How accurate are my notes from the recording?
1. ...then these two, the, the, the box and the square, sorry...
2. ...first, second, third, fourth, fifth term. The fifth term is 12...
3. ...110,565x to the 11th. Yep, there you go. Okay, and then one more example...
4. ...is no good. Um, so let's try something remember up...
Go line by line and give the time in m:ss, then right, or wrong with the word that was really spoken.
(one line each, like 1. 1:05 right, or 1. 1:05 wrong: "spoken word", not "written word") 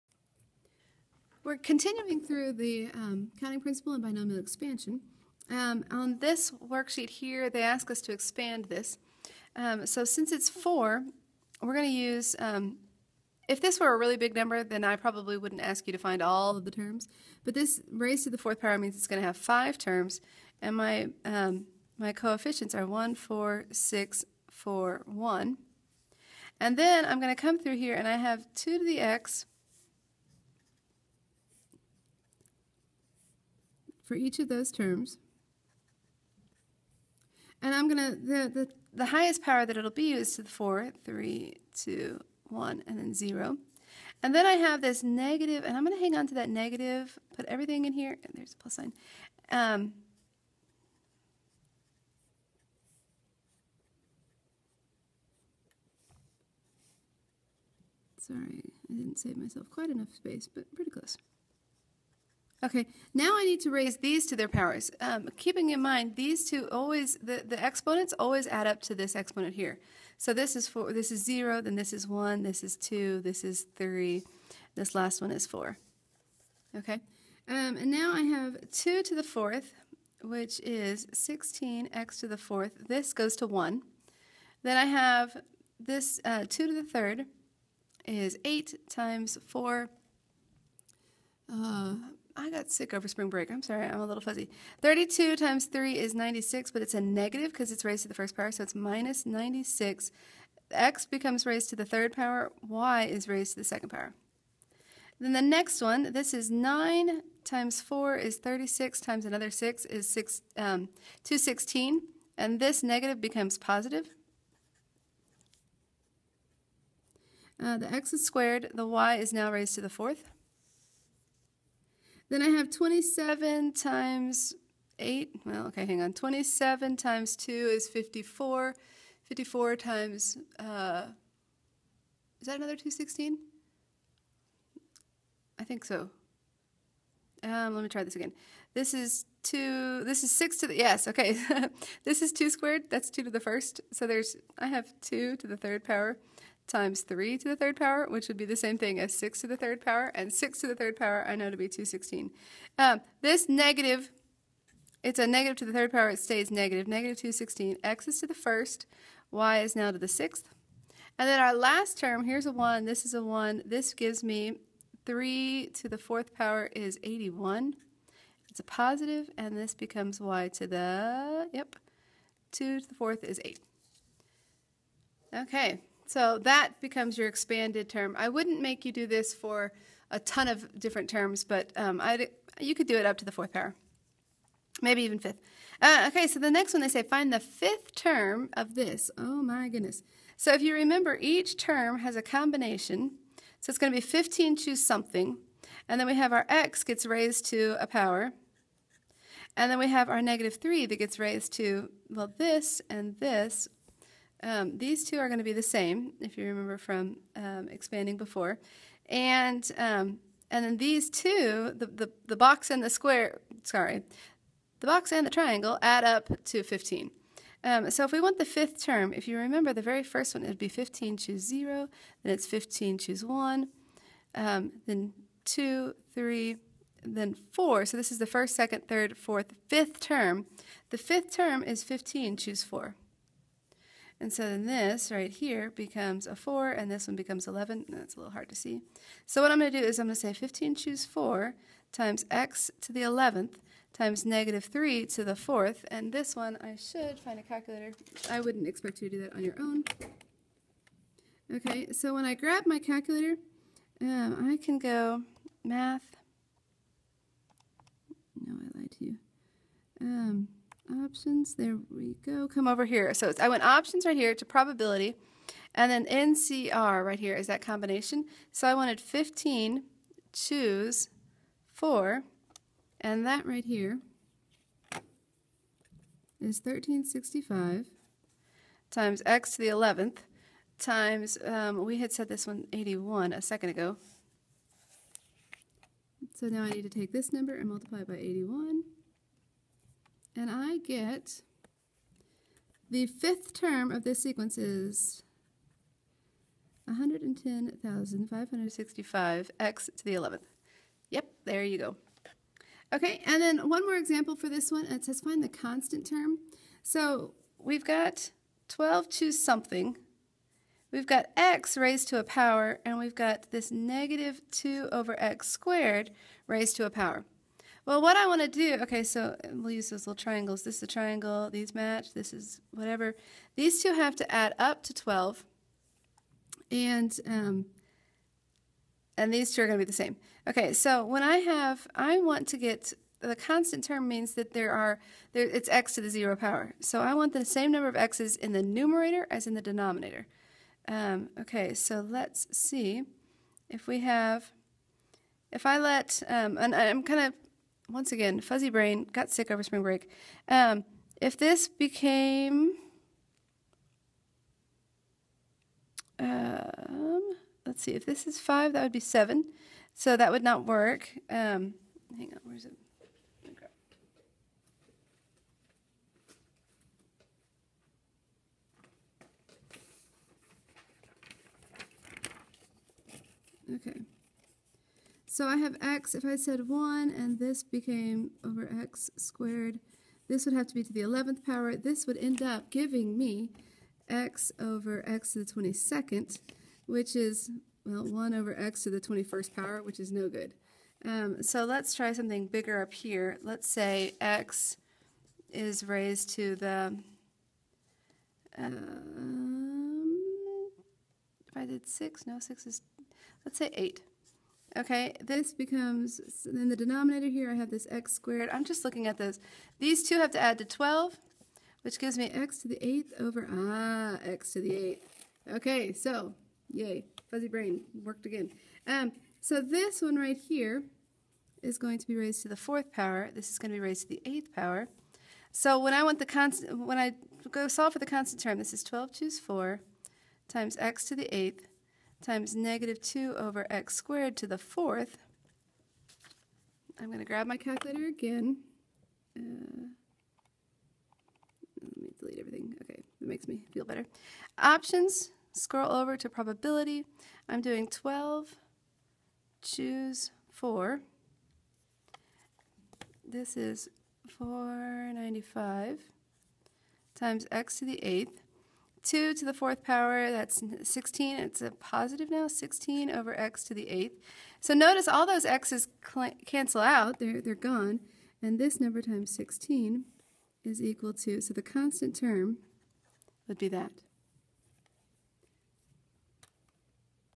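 1. 3:30 right
2. 3:48 wrong: "15", not "12"
3. 4:56 right
4. 6:30 wrong: "bigger", not "remember".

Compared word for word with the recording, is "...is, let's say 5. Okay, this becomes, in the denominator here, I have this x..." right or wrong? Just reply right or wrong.
wrong.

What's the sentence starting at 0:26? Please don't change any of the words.
And then I'm going to come through here, and I have 2 to the x, for each of those terms.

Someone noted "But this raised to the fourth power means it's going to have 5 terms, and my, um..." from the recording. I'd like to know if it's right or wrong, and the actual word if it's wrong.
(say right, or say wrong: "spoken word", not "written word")
right.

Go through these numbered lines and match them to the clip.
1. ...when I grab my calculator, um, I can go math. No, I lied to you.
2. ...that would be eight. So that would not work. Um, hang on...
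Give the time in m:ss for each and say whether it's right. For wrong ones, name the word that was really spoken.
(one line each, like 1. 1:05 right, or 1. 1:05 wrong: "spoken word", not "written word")
1. 4:12 right
2. 5:58 wrong: "seven", not "eight".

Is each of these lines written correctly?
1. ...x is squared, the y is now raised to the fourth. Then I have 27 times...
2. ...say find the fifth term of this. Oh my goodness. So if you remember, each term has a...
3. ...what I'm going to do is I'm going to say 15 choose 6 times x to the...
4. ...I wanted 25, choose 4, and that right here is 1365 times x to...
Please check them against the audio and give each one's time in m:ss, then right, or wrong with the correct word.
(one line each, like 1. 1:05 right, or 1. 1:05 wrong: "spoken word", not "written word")
1. 1:57 right
2. 3:06 right
3. 3:59 wrong: "4", not "6"
4. 4:28 wrong: "15", not "25".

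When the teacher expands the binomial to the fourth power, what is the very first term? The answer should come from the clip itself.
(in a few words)
16x to the fourth.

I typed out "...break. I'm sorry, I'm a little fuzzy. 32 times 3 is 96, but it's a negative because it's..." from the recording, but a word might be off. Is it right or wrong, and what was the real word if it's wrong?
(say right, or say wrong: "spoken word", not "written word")
right.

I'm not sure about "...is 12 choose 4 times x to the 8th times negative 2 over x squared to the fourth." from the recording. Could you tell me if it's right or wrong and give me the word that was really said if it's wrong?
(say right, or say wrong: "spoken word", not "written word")
right.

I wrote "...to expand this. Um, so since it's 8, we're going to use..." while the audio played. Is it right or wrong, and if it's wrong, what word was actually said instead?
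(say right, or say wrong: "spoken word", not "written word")
wrong: "4", not "8".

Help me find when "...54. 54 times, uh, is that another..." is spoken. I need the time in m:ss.
2:07.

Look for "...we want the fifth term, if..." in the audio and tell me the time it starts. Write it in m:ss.
3:38.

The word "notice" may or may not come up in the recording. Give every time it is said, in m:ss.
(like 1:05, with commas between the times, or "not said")
7:44.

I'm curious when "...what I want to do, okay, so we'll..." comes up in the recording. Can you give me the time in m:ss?
5:18.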